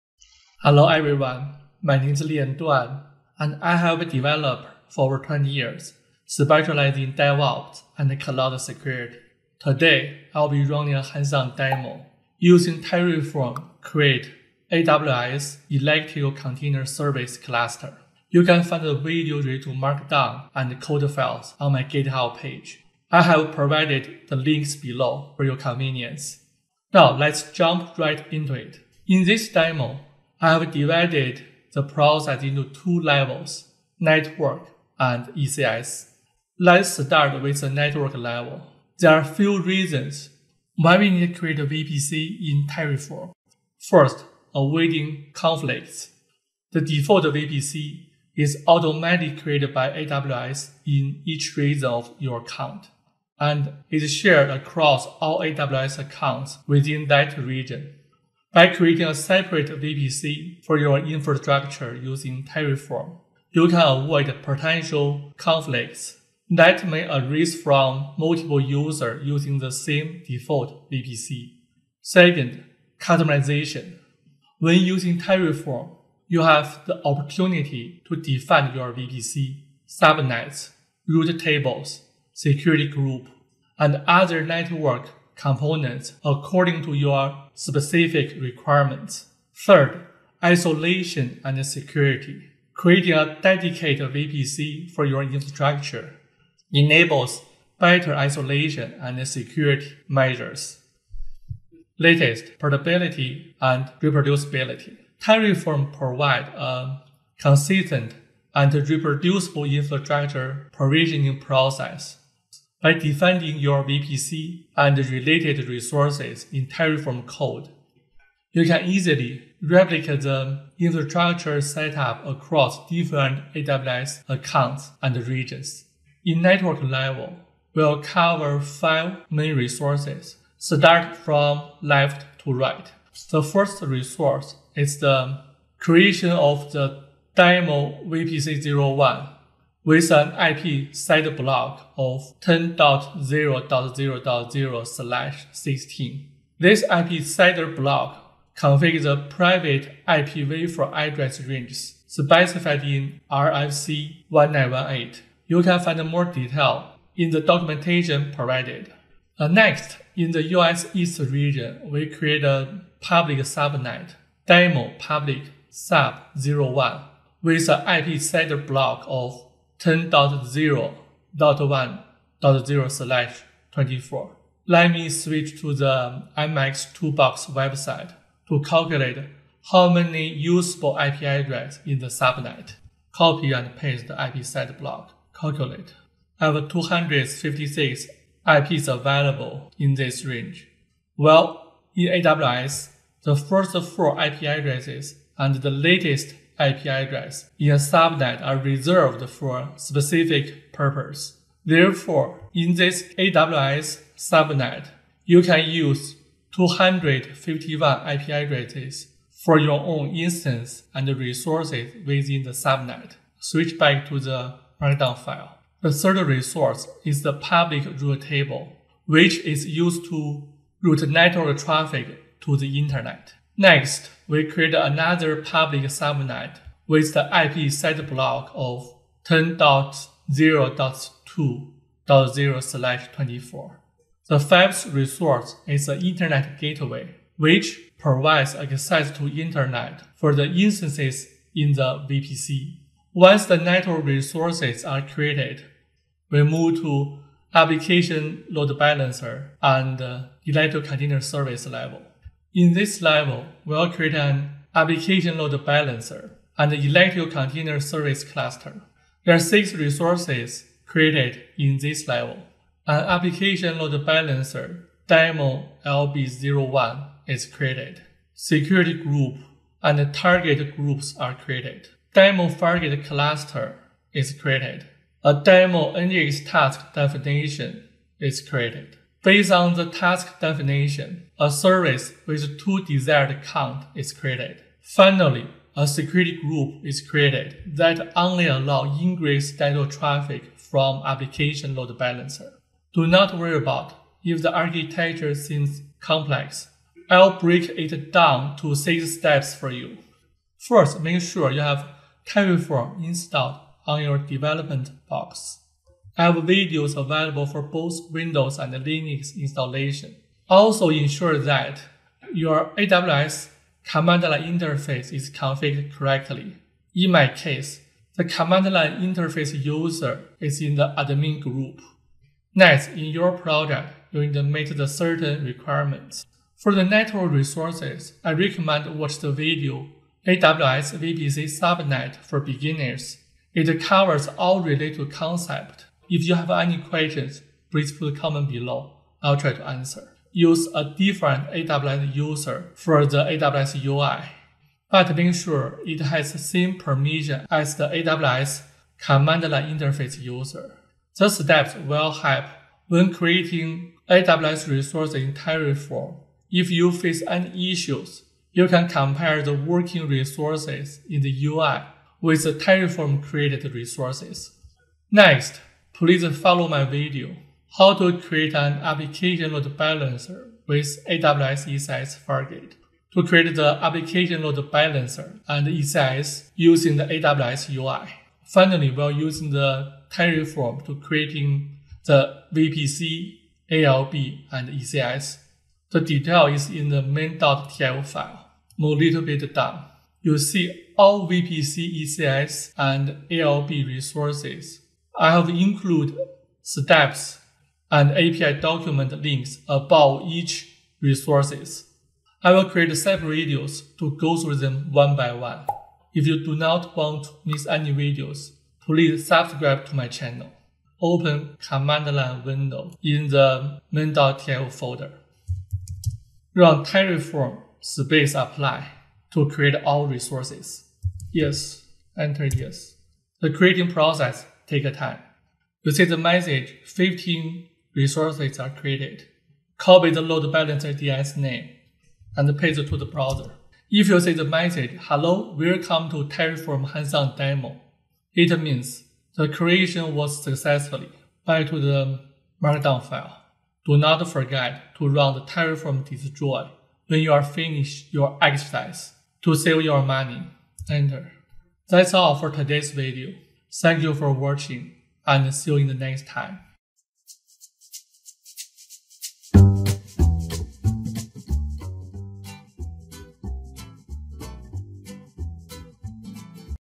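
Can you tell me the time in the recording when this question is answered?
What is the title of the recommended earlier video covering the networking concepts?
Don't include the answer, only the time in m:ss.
5:30.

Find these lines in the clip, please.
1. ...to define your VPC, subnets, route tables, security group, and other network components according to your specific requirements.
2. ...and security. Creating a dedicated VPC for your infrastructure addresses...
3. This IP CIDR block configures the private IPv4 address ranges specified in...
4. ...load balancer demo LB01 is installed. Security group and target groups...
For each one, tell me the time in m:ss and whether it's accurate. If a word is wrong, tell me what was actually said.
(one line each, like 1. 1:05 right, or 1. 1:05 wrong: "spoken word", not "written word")
1. 1:18 right
2. 1:31 wrong: "enables", not "addresses"
3. 2:26 right
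4. 4:23 wrong: "created", not "installed".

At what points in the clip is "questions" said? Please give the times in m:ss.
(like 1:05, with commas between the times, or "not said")
5:36.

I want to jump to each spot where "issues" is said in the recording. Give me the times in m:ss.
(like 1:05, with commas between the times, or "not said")
5:57.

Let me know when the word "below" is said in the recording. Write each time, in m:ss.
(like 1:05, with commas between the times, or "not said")
0:24, 5:38.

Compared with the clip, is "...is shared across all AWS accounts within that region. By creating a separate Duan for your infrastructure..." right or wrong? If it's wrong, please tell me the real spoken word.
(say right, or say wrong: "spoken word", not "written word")
wrong: "VPC", not "Duan".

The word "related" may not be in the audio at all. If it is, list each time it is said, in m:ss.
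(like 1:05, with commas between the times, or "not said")
0:19, 1:54, 5:34.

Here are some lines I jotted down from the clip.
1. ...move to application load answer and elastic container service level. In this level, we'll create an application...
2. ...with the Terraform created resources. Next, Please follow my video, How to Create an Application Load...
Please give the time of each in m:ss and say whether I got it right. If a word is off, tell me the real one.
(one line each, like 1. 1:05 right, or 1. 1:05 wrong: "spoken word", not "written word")
1. 4:06 wrong: "balancer", not "answer"
2. 6:02 right.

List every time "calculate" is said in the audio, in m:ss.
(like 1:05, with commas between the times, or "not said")
2:58, 3:05.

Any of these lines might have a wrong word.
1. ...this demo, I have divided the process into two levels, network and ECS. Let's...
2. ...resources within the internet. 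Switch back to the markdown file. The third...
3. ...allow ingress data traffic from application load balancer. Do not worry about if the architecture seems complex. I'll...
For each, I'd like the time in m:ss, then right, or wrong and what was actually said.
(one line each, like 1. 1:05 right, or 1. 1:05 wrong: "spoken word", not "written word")
1. 0:29 right
2. 3:31 wrong: "subnet", not "internet"
3. 4:48 right.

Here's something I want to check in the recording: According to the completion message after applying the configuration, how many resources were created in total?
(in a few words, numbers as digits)
15.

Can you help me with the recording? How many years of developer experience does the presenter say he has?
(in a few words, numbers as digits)
over 20.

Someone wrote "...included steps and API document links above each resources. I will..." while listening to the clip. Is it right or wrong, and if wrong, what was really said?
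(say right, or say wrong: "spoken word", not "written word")
right.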